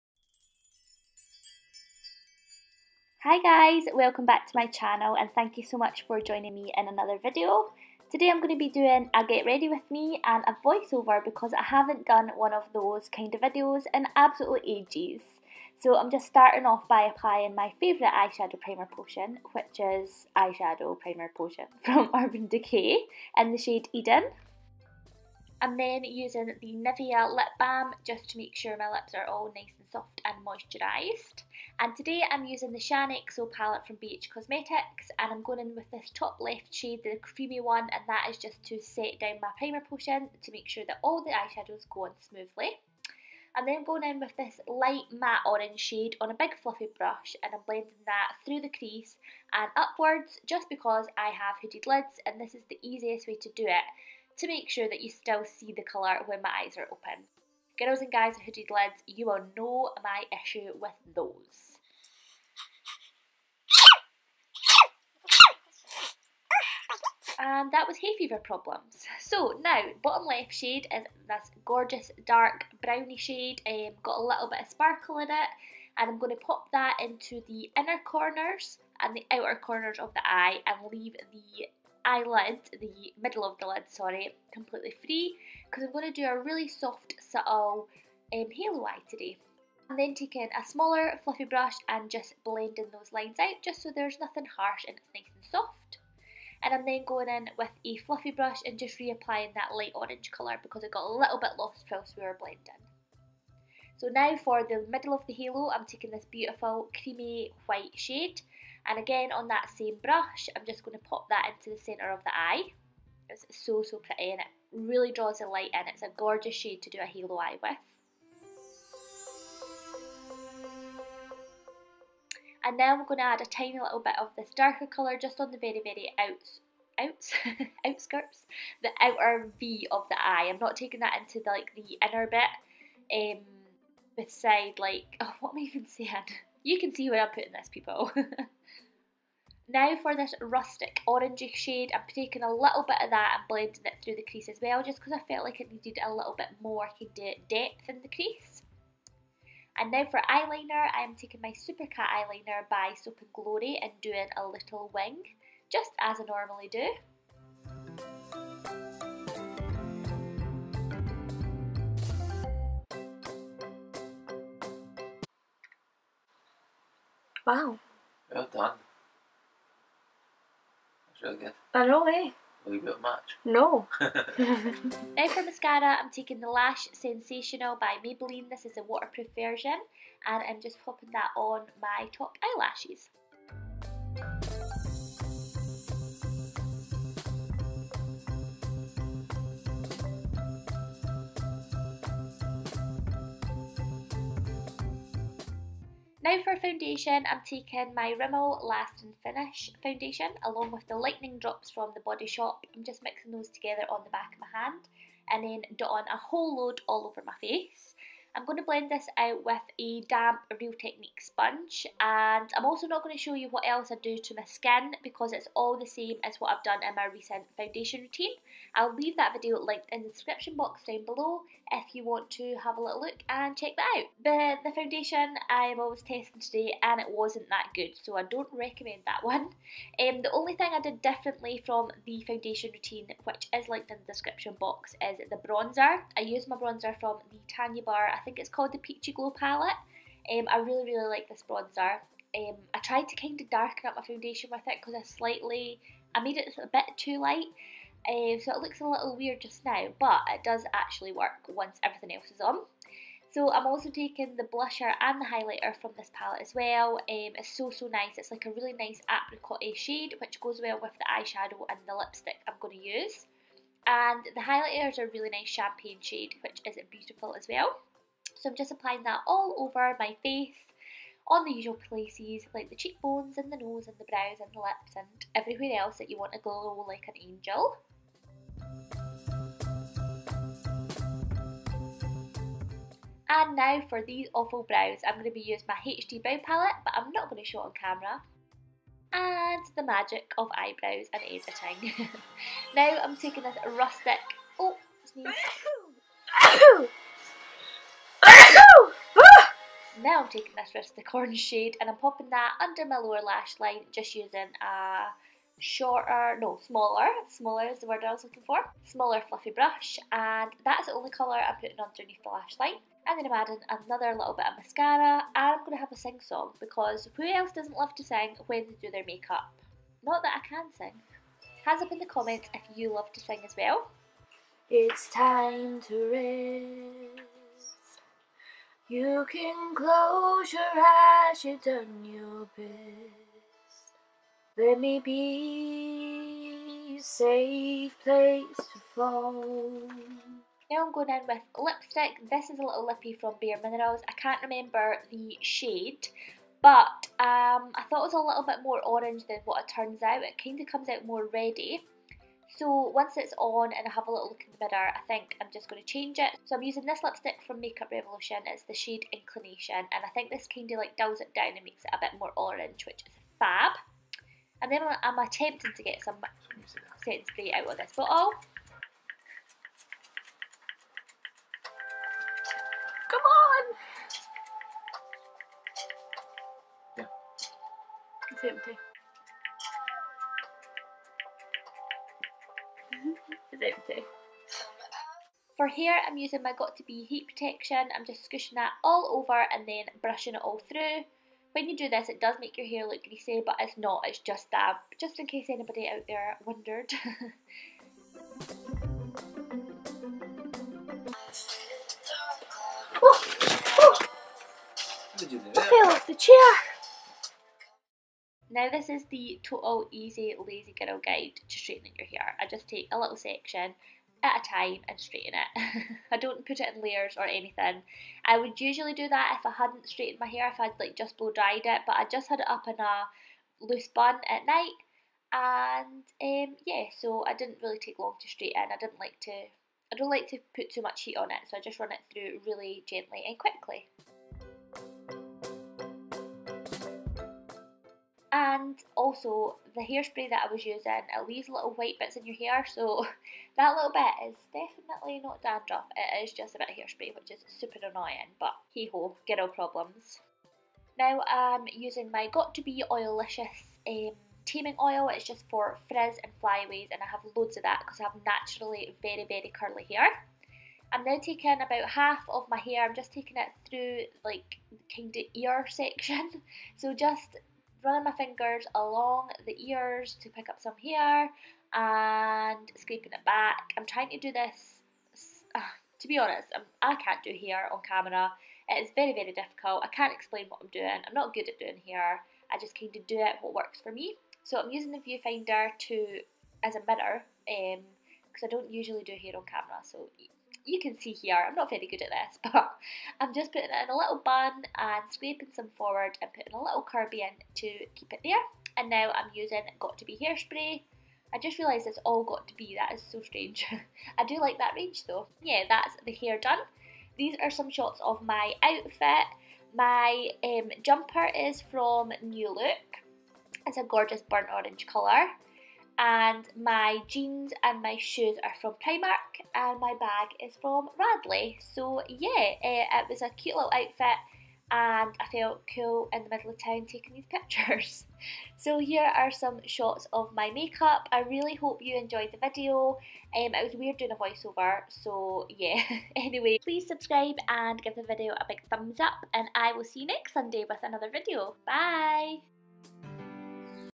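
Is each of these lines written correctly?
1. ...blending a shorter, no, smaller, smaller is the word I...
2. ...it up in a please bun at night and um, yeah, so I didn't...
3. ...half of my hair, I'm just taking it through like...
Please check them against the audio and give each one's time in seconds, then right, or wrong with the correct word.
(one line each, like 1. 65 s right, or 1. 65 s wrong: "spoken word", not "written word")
1. 304 s wrong: "using", not "blending"
2. 422 s wrong: "loose", not "please"
3. 461 s right.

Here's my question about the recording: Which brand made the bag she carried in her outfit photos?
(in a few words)
Radley.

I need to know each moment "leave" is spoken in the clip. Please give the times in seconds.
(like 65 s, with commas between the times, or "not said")
80 s, 218 s, 441 s.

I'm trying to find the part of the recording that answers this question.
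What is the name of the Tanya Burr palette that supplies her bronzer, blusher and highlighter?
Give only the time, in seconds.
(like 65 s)
238 s.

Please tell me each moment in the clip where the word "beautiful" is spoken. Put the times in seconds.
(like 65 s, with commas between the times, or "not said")
106 s, 266 s.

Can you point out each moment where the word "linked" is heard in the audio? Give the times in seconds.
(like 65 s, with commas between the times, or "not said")
219 s, 233 s.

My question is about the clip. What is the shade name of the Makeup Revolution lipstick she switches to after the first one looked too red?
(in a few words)
Inclination.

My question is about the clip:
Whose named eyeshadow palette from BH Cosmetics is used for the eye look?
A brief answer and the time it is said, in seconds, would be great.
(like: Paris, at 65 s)
Shaaanxo, at 32 s.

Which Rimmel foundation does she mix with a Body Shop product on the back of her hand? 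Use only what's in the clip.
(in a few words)
Lasting Finish.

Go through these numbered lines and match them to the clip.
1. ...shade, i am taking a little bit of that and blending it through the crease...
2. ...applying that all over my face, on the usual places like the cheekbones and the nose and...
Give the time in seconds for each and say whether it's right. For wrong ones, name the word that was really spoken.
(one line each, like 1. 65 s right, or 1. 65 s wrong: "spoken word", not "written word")
1. 141 s right
2. 268 s right.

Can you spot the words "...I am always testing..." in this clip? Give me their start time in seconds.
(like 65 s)
225 s.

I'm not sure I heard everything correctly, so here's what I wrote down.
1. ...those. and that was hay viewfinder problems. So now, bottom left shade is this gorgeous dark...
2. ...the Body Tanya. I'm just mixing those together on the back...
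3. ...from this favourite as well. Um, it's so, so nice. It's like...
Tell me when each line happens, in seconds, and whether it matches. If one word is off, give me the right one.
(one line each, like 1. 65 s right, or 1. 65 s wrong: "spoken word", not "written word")
1. 61 s wrong: "fever", not "viewfinder"
2. 201 s wrong: "Shop", not "Tanya"
3. 255 s wrong: "palette", not "favourite".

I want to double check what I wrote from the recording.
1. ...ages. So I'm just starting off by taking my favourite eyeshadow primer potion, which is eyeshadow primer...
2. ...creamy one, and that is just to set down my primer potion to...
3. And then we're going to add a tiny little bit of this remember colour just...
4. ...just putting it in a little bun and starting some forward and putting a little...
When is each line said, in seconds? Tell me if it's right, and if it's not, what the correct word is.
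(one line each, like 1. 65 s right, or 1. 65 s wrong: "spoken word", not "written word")
1. 14 s wrong: "applying", not "taking"
2. 37 s right
3. 122 s wrong: "darker", not "remember"
4. 493 s wrong: "scraping", not "starting".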